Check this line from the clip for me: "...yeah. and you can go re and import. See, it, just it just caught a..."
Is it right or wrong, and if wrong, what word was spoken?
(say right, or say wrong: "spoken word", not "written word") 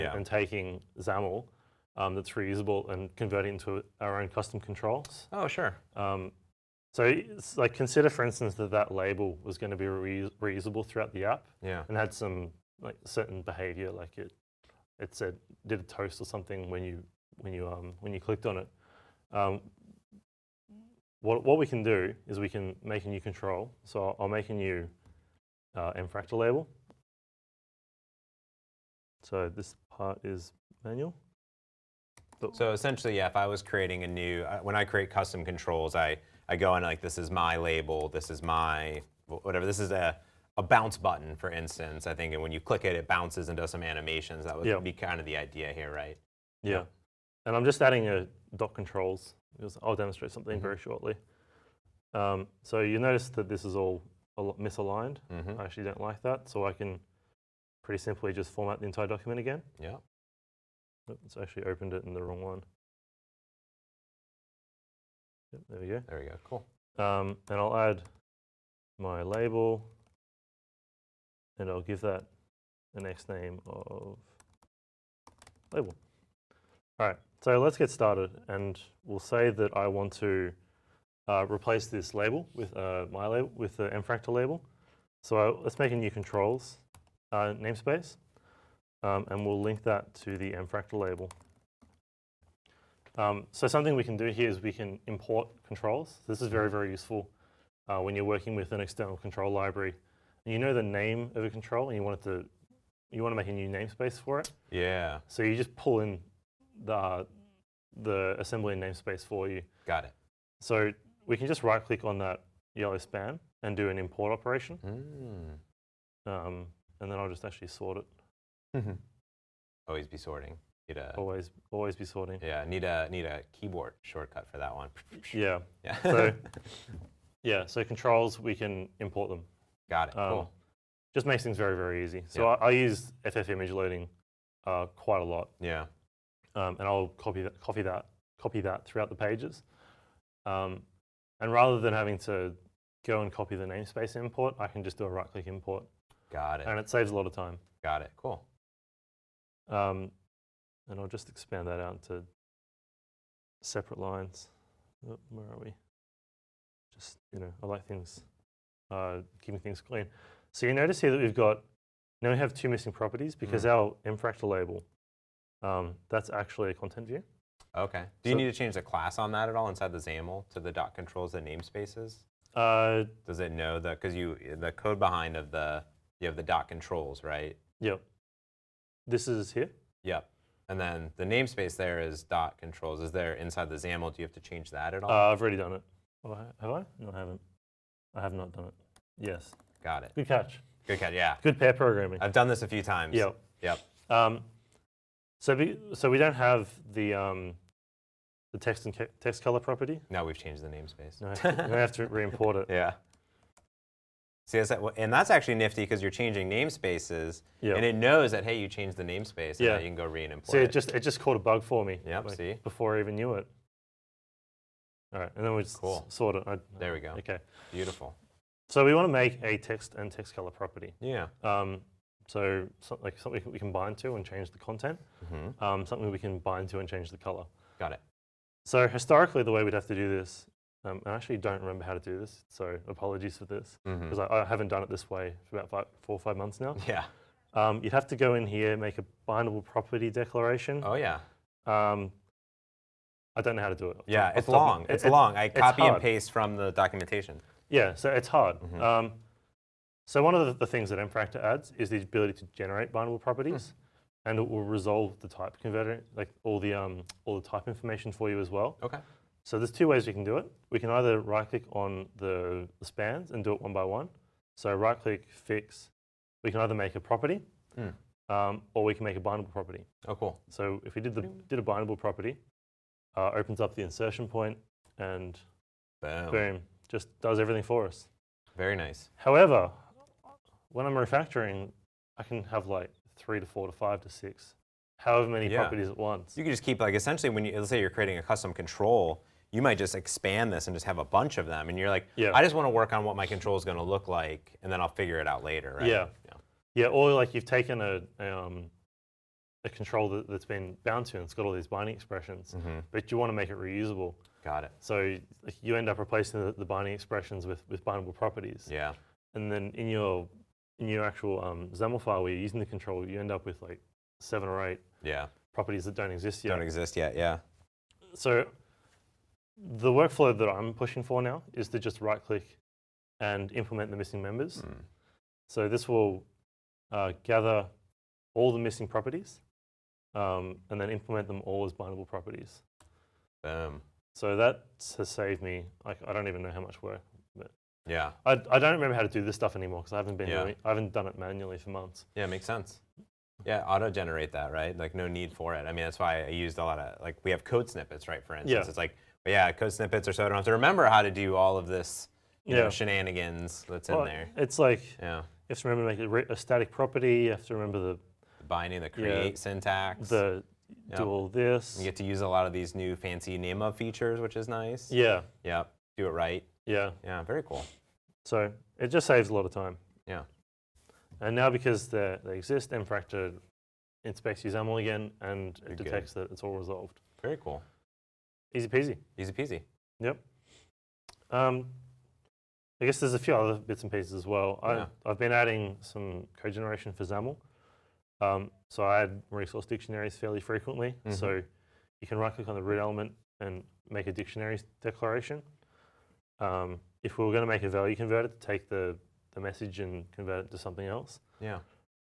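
right.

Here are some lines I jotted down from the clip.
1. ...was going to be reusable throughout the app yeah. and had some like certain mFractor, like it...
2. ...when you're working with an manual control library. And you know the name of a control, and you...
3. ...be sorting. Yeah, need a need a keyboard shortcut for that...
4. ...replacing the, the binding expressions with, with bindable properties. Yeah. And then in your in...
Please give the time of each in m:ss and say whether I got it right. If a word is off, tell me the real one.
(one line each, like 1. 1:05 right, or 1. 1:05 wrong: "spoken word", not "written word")
1. 0:09 wrong: "behavior", not "mFractor"
2. 1:37 wrong: "external", not "manual"
3. 2:01 right
4. 5:05 right.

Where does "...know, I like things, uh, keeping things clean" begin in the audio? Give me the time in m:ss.
2:37.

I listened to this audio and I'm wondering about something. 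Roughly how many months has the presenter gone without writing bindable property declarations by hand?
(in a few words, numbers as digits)
4 or 5 months.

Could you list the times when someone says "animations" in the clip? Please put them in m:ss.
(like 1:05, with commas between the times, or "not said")
0:43.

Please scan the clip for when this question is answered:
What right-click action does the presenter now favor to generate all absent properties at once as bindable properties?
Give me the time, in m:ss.
5:23.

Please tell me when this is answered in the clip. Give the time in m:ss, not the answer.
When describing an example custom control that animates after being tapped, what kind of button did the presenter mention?
0:40.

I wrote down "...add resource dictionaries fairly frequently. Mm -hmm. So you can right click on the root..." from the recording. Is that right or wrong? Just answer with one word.
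right.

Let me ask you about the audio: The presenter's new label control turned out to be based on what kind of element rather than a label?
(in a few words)
content view.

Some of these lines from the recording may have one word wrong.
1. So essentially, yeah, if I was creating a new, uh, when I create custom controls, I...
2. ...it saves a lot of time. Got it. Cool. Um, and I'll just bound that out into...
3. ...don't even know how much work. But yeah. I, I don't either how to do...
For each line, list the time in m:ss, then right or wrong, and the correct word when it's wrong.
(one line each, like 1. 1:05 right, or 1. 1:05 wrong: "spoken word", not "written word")
1. 0:32 right
2. 2:26 wrong: "expand", not "bound"
3. 5:36 wrong: "remember", not "either".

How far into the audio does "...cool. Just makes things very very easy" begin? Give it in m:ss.
2:10.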